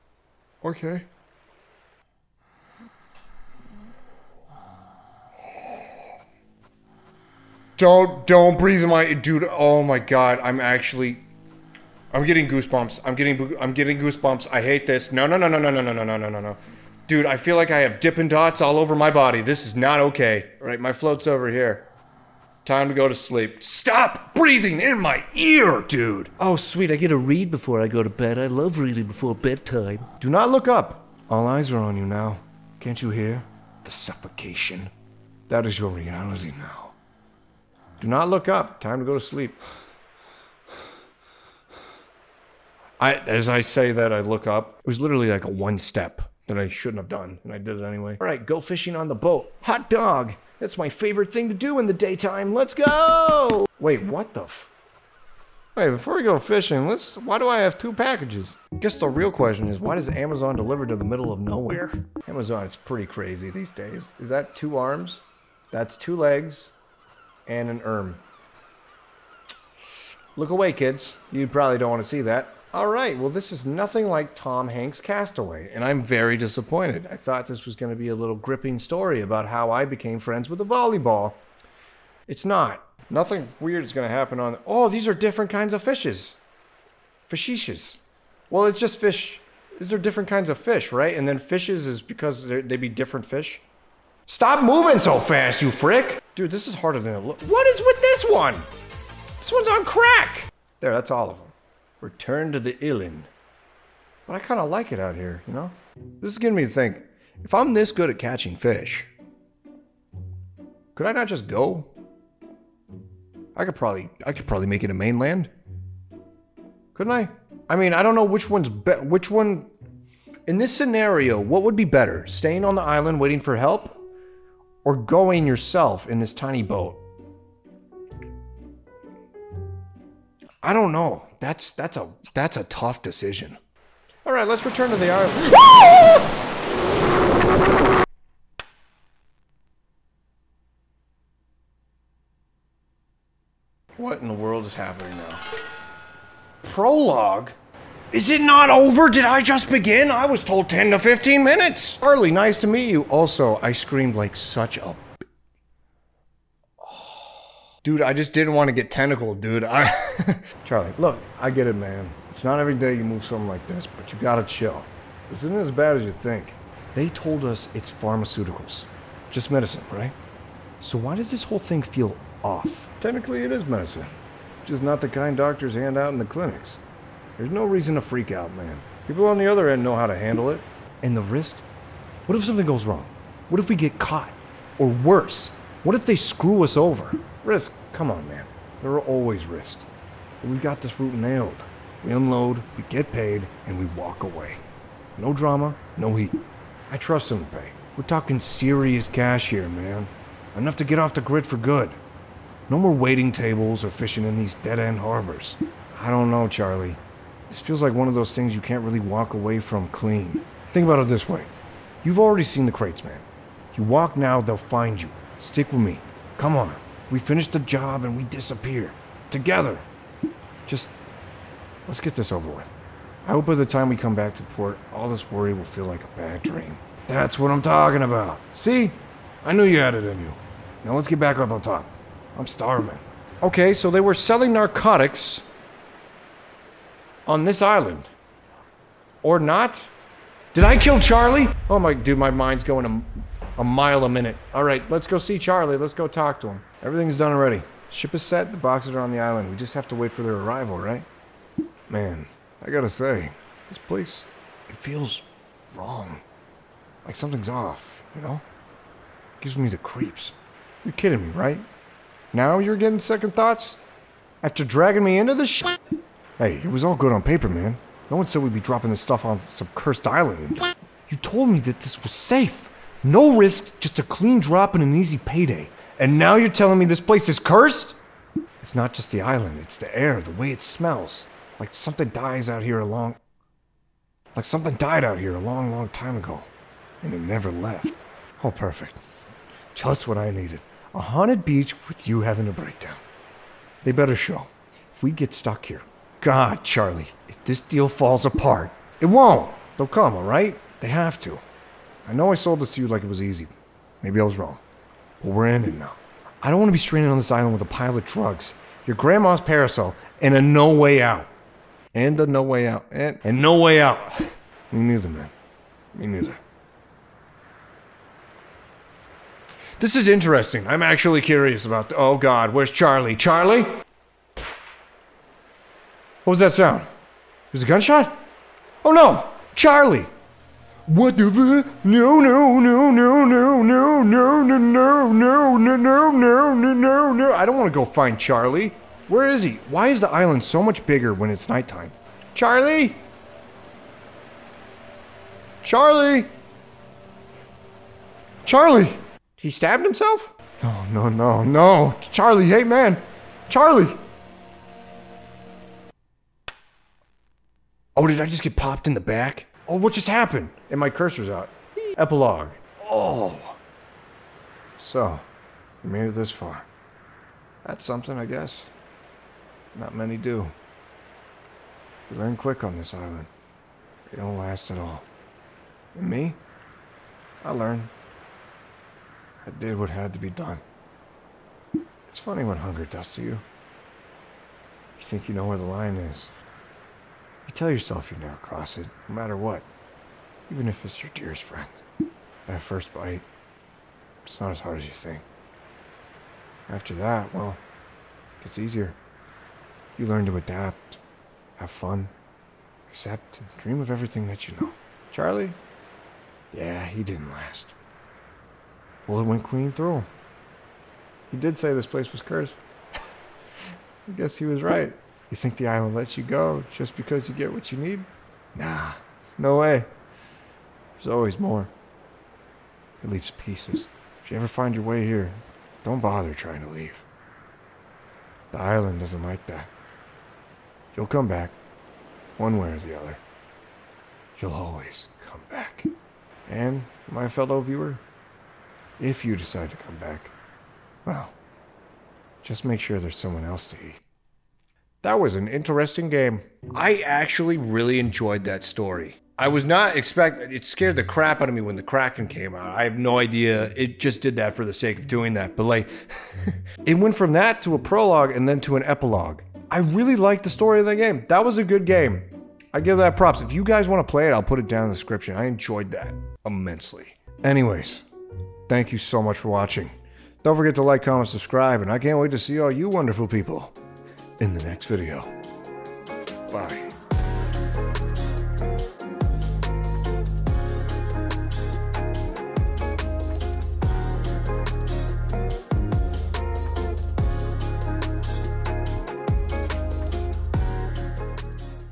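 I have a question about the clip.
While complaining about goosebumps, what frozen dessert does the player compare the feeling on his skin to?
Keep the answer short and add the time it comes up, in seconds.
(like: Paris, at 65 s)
Dipping dots, at 18 s.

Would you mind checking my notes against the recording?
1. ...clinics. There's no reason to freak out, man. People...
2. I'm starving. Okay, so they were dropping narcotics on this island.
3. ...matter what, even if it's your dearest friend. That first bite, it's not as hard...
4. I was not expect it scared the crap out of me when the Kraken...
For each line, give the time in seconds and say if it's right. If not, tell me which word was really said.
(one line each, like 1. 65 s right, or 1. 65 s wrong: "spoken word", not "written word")
1. 176 s right
2. 232 s wrong: "selling", not "dropping"
3. 389 s right
4. 449 s right.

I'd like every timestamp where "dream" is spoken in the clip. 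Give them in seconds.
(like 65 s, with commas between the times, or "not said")
226 s, 403 s.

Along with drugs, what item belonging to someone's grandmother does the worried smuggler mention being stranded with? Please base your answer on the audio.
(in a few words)
Grandma's parasol.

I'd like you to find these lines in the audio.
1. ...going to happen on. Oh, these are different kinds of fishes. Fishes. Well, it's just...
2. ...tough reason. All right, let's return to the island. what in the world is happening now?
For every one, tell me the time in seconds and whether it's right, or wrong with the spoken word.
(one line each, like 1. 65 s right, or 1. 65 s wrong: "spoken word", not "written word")
1. 83 s right
2. 132 s wrong: "decision", not "reason".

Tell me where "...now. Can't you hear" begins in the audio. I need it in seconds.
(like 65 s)
32 s.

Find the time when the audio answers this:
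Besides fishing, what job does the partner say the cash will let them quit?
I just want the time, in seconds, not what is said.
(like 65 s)
202 s.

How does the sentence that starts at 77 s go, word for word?
I thought this was going to be a little gripping story about how I became friends with a volleyball.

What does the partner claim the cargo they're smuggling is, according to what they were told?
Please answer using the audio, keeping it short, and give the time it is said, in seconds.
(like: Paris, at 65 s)
Pharmaceuticals, at 167 s.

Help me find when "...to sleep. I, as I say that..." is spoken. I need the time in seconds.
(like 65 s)
39 s.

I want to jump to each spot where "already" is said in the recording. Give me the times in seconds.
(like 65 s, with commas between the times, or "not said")
212 s, 247 s.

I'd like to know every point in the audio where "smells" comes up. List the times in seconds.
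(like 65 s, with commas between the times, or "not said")
280 s.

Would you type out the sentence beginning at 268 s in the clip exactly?
No one said we'd be dropping this stuff on some cursed island.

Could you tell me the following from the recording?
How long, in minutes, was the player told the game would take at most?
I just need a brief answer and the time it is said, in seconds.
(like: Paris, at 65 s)
15, at 150 s.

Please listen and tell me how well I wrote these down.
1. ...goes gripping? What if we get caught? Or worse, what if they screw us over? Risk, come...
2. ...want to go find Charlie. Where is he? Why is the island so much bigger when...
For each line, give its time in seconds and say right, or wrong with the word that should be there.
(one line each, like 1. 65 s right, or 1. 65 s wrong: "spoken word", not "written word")
1. 182 s wrong: "wrong", not "gripping"
2. 337 s right.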